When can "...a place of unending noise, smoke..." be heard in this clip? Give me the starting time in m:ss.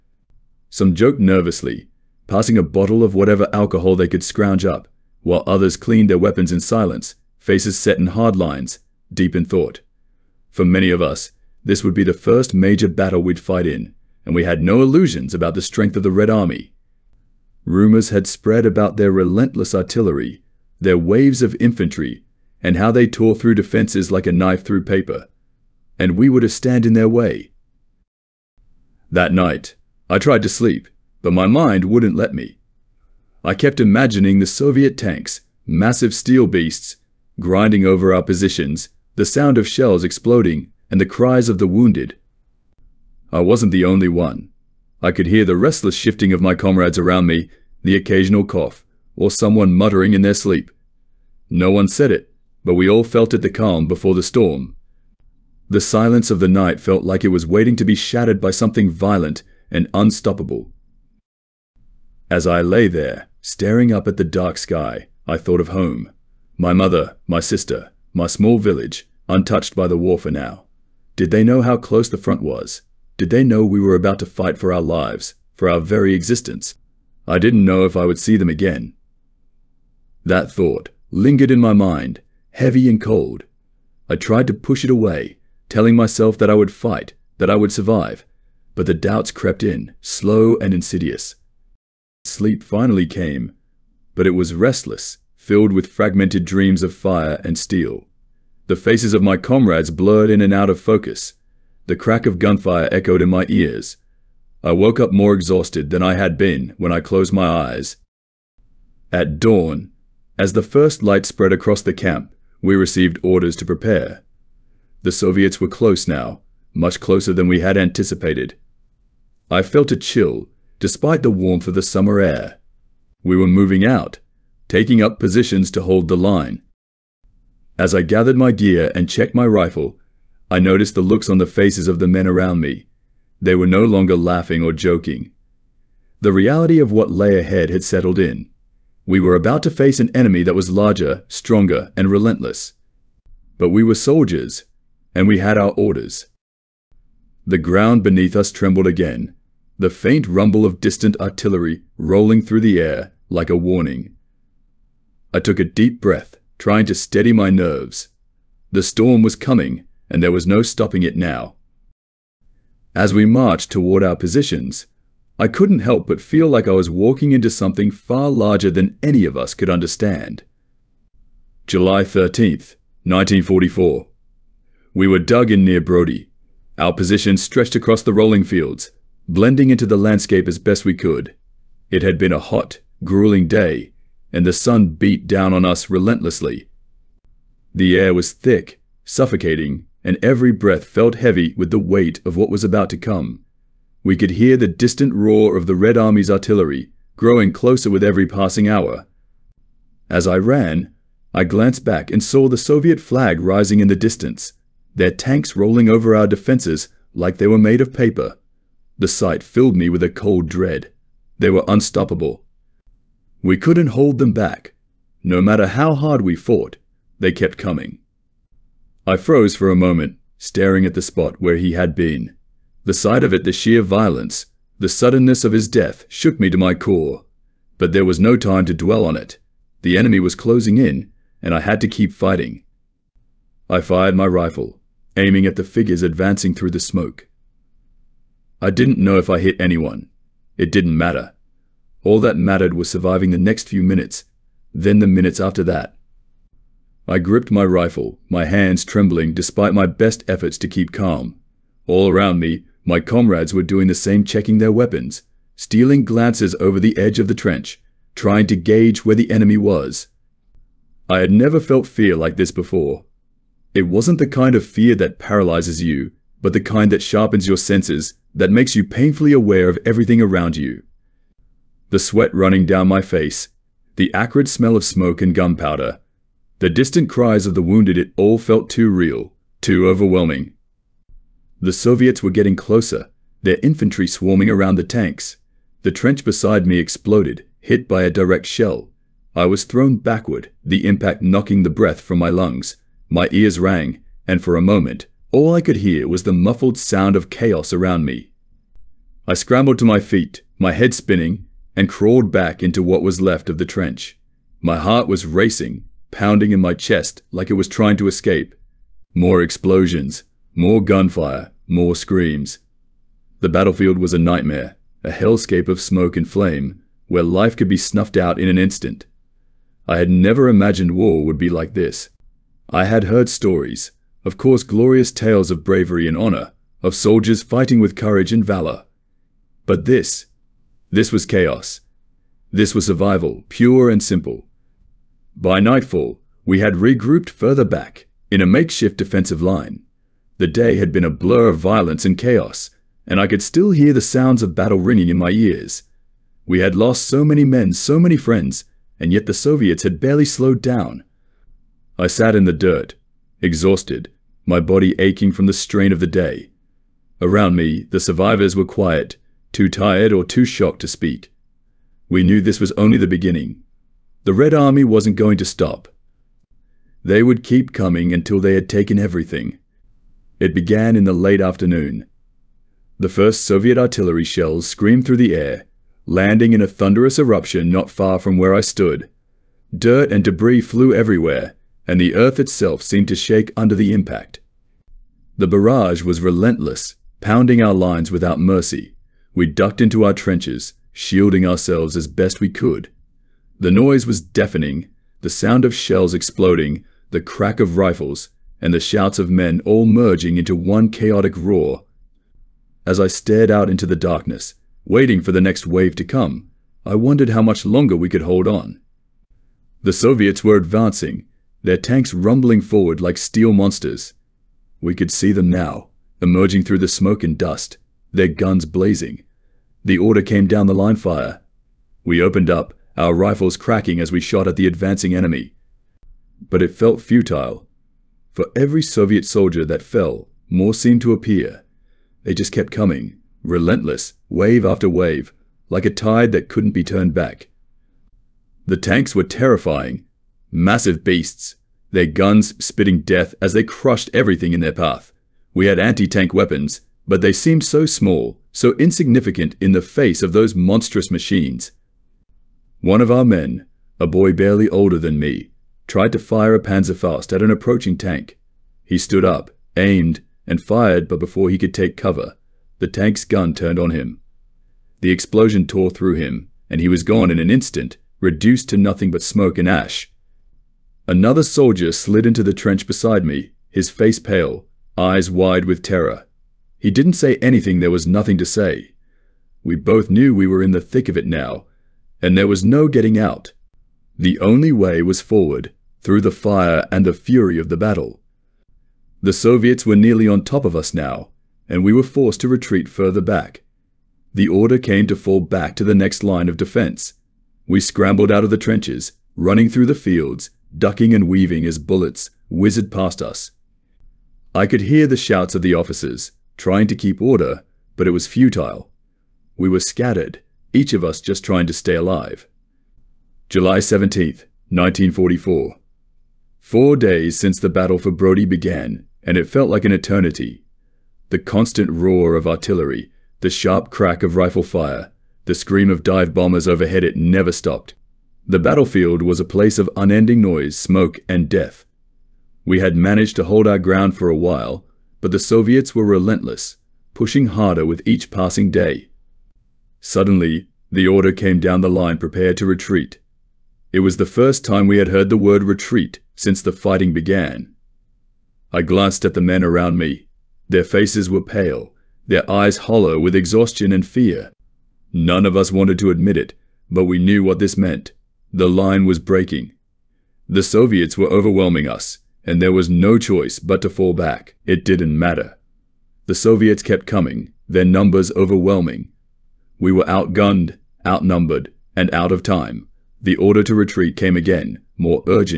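8:49.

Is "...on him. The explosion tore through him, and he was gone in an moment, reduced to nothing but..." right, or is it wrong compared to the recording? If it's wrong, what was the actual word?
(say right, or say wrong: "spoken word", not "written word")
wrong: "instant", not "moment".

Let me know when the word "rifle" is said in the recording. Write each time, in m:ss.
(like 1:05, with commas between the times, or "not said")
2:09, 3:54, 4:07, 6:37, 7:03, 8:44.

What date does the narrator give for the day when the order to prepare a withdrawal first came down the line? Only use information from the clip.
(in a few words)
July 17, 1944.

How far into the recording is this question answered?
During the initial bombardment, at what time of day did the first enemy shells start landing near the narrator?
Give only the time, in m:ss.
6:11.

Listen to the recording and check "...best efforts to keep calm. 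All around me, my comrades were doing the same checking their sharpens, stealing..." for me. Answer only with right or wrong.
wrong.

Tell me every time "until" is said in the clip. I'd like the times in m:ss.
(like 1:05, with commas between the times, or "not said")
6:08.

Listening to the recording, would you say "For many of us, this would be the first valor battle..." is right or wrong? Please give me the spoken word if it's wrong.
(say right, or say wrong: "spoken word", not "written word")
wrong: "major", not "valor".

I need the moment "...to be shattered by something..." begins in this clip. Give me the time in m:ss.
0:57.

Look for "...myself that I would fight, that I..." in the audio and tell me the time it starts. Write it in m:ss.
1:25.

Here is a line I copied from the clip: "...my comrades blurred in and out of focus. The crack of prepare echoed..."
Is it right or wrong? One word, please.
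wrong.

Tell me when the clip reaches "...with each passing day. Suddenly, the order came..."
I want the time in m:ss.
8:57.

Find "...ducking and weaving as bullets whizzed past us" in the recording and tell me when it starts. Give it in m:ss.
8:20.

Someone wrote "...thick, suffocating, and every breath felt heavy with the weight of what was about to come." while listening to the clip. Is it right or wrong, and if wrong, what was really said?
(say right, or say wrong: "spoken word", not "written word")
right.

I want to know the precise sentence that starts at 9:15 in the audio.
None of us wanted to admit it, but we knew what this meant.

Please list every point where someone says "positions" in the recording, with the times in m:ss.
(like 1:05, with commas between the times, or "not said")
0:38, 2:05, 2:44, 2:56.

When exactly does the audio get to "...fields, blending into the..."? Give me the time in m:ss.
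2:58.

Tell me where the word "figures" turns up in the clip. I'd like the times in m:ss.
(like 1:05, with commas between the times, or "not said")
3:55.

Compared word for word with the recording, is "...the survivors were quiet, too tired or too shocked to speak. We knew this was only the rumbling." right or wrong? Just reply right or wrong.
wrong.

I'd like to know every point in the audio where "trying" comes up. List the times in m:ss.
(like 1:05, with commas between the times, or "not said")
2:36, 4:18, 5:07, 8:26, 8:31.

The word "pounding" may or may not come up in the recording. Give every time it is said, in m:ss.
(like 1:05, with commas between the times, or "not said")
5:06, 6:27.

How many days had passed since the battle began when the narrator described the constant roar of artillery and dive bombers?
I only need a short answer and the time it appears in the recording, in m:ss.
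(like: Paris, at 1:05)
4, at 8:36.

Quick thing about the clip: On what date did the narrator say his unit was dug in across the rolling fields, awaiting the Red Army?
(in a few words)
July 13th, 1944.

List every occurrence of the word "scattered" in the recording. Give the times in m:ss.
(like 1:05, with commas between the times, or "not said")
8:29.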